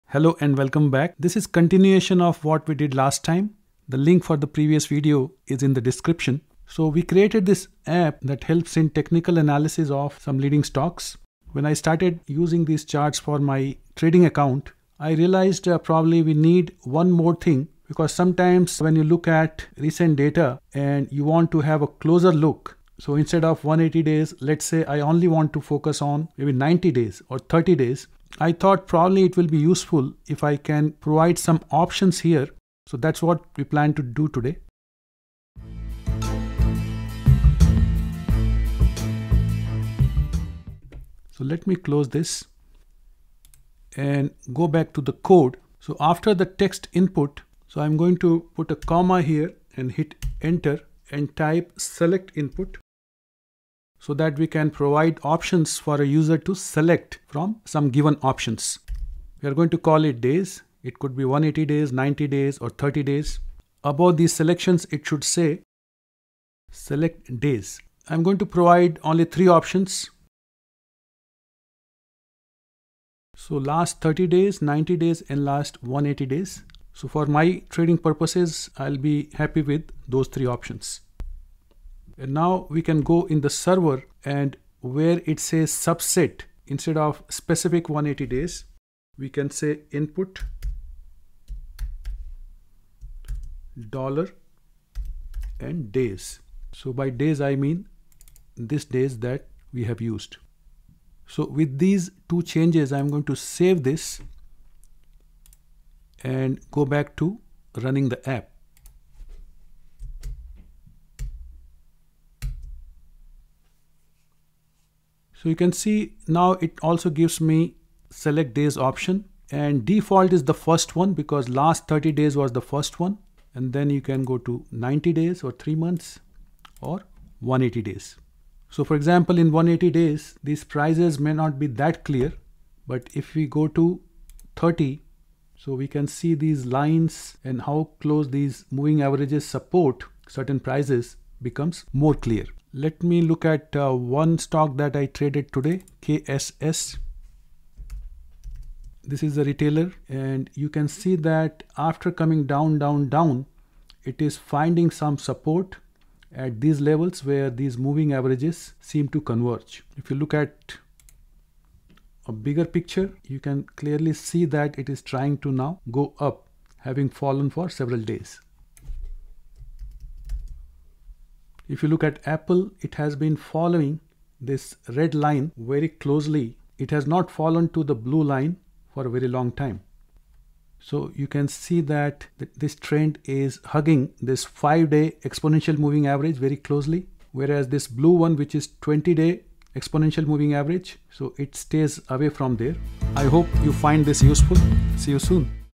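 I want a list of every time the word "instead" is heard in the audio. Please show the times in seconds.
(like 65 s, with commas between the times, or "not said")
23 s, 86 s.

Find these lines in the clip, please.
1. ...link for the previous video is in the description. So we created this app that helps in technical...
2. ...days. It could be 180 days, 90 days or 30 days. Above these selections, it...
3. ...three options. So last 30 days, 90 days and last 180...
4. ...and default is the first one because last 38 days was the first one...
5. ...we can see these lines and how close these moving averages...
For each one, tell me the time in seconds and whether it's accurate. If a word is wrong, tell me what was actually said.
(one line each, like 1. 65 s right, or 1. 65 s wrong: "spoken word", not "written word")
1. 3 s right
2. 60 s right
3. 69 s right
4. 119 s wrong: "30", not "38"
5. 135 s right.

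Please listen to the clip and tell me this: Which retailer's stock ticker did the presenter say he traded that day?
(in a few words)
KSS.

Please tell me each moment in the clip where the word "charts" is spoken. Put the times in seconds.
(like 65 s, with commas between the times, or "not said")
12 s.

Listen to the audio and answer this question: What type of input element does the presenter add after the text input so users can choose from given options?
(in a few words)
select input.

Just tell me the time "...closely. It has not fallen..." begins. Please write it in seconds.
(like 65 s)
175 s.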